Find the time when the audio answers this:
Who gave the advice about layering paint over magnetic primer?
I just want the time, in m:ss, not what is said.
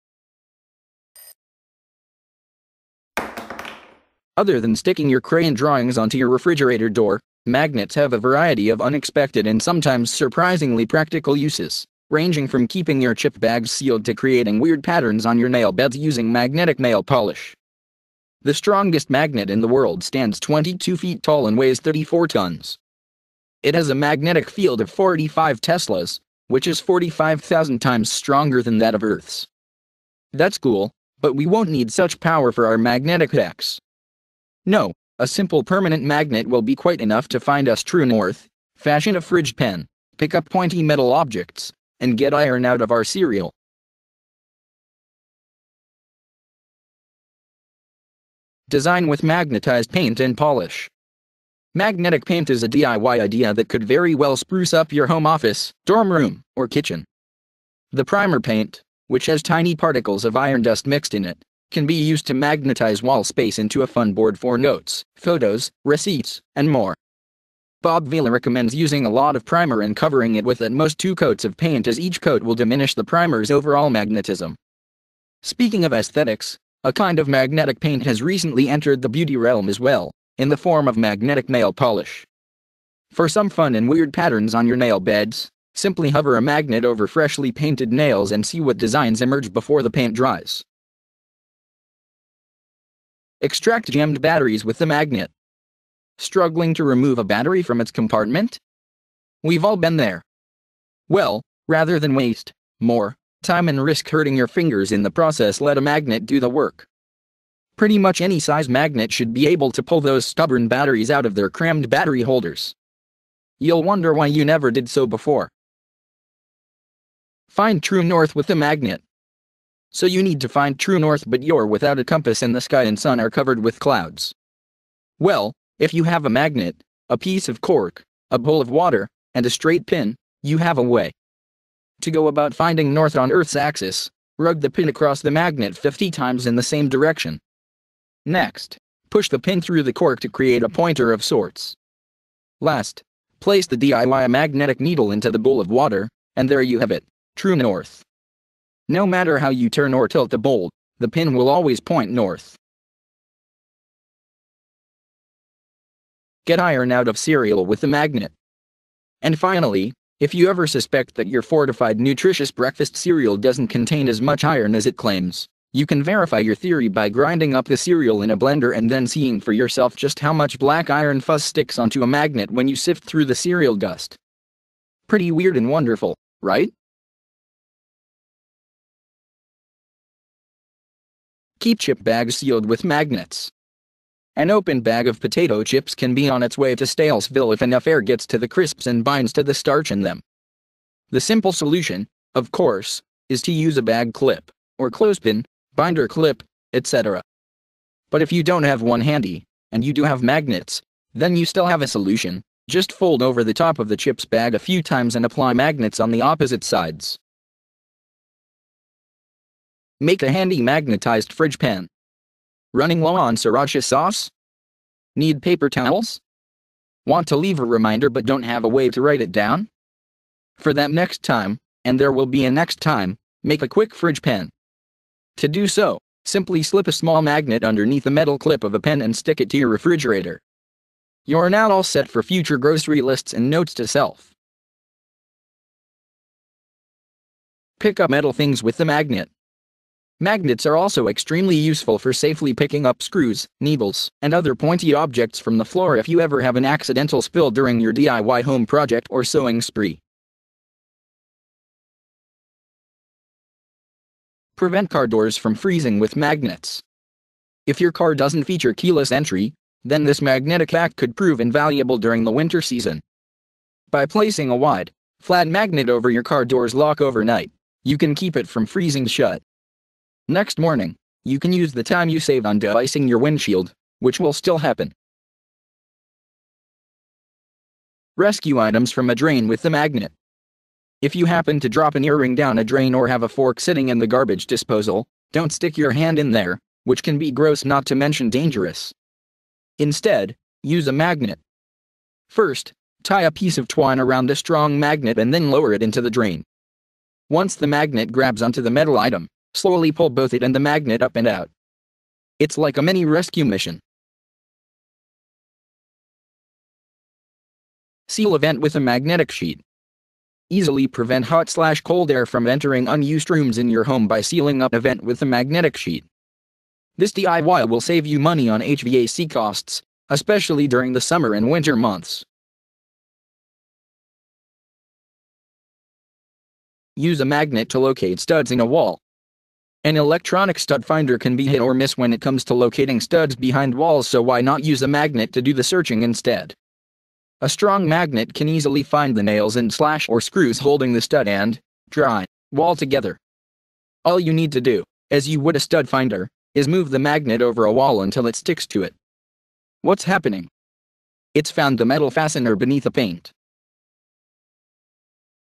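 1:07.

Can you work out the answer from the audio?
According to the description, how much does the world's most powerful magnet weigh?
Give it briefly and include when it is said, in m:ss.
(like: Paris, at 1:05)
34 tons, at 0:21.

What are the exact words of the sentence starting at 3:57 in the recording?
Pick up metal things with the magnet.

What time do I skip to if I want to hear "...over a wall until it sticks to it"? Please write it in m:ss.
5:47.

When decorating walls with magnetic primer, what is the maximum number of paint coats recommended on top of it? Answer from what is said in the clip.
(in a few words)
2.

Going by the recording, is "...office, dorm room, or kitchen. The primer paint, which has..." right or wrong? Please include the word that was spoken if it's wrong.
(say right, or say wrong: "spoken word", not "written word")
right.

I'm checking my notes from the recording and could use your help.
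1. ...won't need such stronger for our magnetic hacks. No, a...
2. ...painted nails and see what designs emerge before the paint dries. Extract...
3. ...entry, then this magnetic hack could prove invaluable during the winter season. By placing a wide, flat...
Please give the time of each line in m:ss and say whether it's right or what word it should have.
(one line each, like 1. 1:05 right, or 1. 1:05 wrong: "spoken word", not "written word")
1. 0:31 wrong: "power", not "stronger"
2. 1:27 right
3. 4:19 right.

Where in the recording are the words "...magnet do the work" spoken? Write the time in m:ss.
1:45.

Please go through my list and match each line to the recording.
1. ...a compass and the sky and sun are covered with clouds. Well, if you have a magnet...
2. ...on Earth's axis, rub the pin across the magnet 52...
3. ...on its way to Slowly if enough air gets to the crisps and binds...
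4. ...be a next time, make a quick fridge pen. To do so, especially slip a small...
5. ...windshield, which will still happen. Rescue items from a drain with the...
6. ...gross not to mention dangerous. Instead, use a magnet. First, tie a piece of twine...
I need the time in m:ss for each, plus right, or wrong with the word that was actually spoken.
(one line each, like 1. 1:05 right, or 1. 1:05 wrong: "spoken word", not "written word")
1. 2:01 right
2. 2:13 wrong: "50", not "52"
3. 3:06 wrong: "Stalesville", not "Slowly"
4. 3:42 wrong: "simply", not "especially"
5. 4:33 right
6. 4:47 right.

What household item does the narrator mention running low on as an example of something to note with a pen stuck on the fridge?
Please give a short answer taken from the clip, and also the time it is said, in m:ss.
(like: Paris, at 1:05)
sriracha sauce, at 3:33.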